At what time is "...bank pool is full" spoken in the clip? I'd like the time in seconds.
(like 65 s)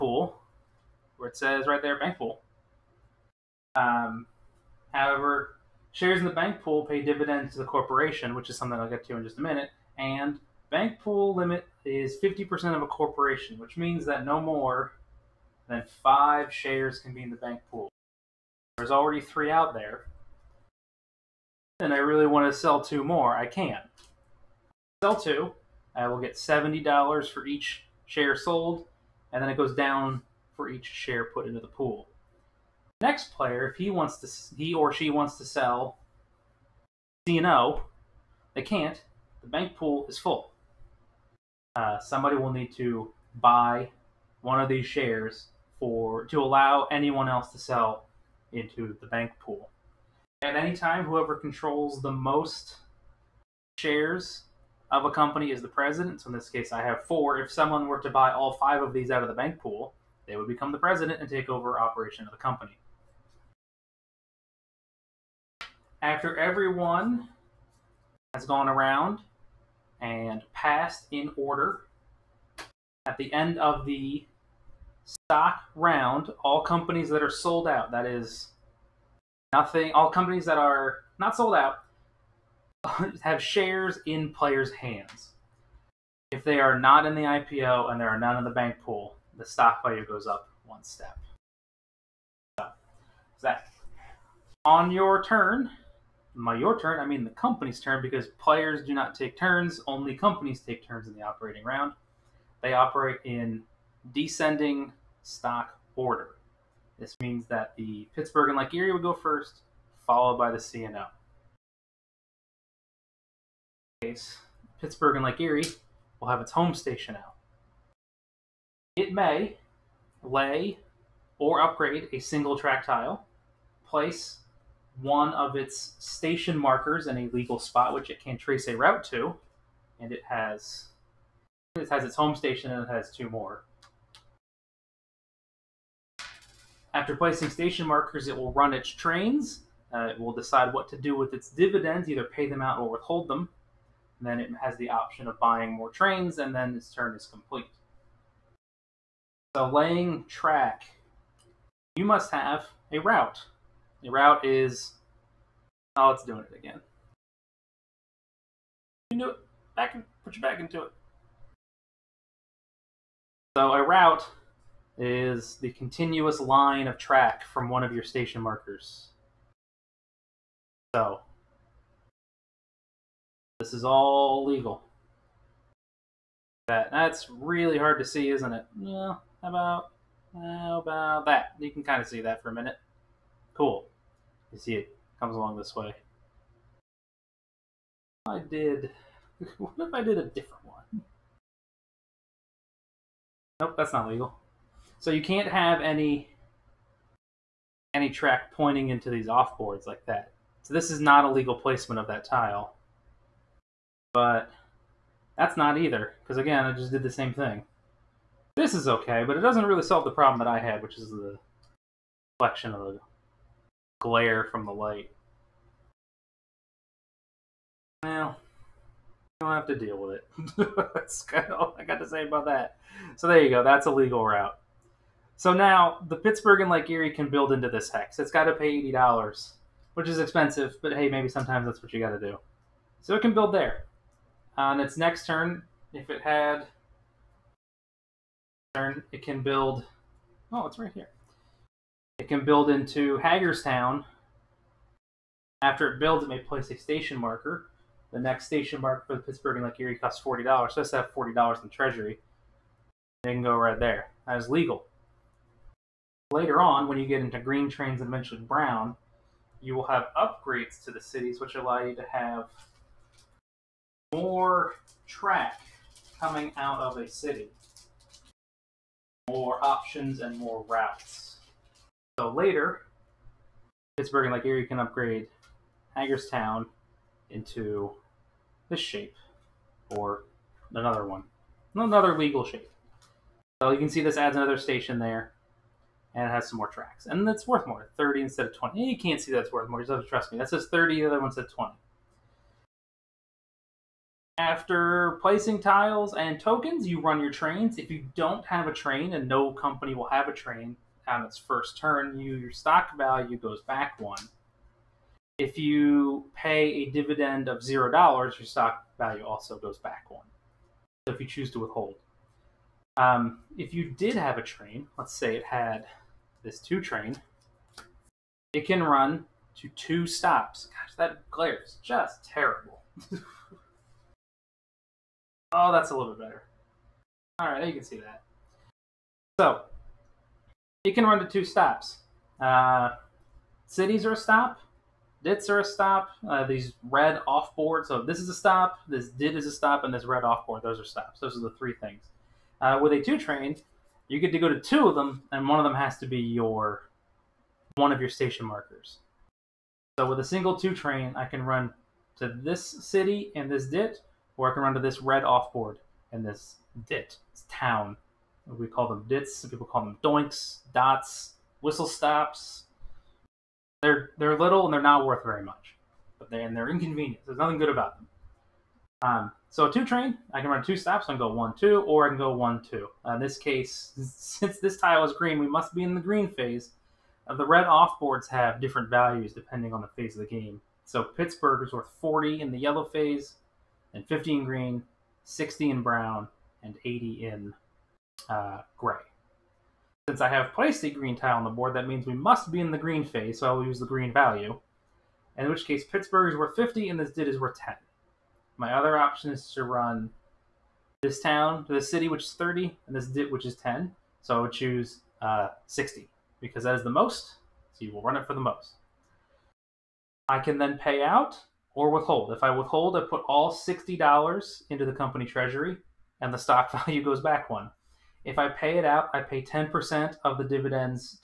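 39 s.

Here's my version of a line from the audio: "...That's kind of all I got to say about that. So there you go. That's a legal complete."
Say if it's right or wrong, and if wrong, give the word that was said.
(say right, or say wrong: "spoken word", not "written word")
wrong: "route", not "complete".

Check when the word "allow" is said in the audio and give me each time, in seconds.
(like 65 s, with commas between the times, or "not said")
46 s, 261 s.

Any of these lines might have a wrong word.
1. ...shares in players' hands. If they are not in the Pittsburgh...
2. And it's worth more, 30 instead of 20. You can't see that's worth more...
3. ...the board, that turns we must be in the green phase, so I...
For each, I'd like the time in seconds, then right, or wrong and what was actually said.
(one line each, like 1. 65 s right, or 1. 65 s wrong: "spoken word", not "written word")
1. 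83 s wrong: "IPO", not "Pittsburgh"
2. 287 s right
3. 391 s wrong: "means", not "turns".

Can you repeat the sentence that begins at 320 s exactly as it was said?
Gosh, that glare is just terrible.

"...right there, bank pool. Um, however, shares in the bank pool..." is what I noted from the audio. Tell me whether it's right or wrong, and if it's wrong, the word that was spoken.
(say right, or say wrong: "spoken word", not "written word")
right.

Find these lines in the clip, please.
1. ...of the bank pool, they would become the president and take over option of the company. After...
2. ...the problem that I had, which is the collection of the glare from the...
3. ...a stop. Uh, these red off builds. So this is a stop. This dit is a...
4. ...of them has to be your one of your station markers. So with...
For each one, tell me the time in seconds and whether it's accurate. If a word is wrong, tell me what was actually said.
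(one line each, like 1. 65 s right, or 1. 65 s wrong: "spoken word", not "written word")
1. 59 s wrong: "operation", not "option"
2. 210 s right
3. 335 s wrong: "boards", not "builds"
4. 345 s right.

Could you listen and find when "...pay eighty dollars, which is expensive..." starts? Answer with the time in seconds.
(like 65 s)
228 s.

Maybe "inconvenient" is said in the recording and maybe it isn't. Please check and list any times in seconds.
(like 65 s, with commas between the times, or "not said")
366 s.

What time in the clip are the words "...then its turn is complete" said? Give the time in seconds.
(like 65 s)
146 s.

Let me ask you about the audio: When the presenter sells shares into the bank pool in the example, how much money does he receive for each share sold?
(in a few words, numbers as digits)
$70.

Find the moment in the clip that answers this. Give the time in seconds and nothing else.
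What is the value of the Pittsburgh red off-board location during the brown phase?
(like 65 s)
385 s.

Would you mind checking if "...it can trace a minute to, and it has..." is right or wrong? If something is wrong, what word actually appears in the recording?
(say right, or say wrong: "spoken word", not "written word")
wrong: "route", not "minute".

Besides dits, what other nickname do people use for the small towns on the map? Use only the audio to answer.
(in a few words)
doinks.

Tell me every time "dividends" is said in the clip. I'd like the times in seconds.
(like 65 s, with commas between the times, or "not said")
7 s, 141 s, 306 s, 420 s.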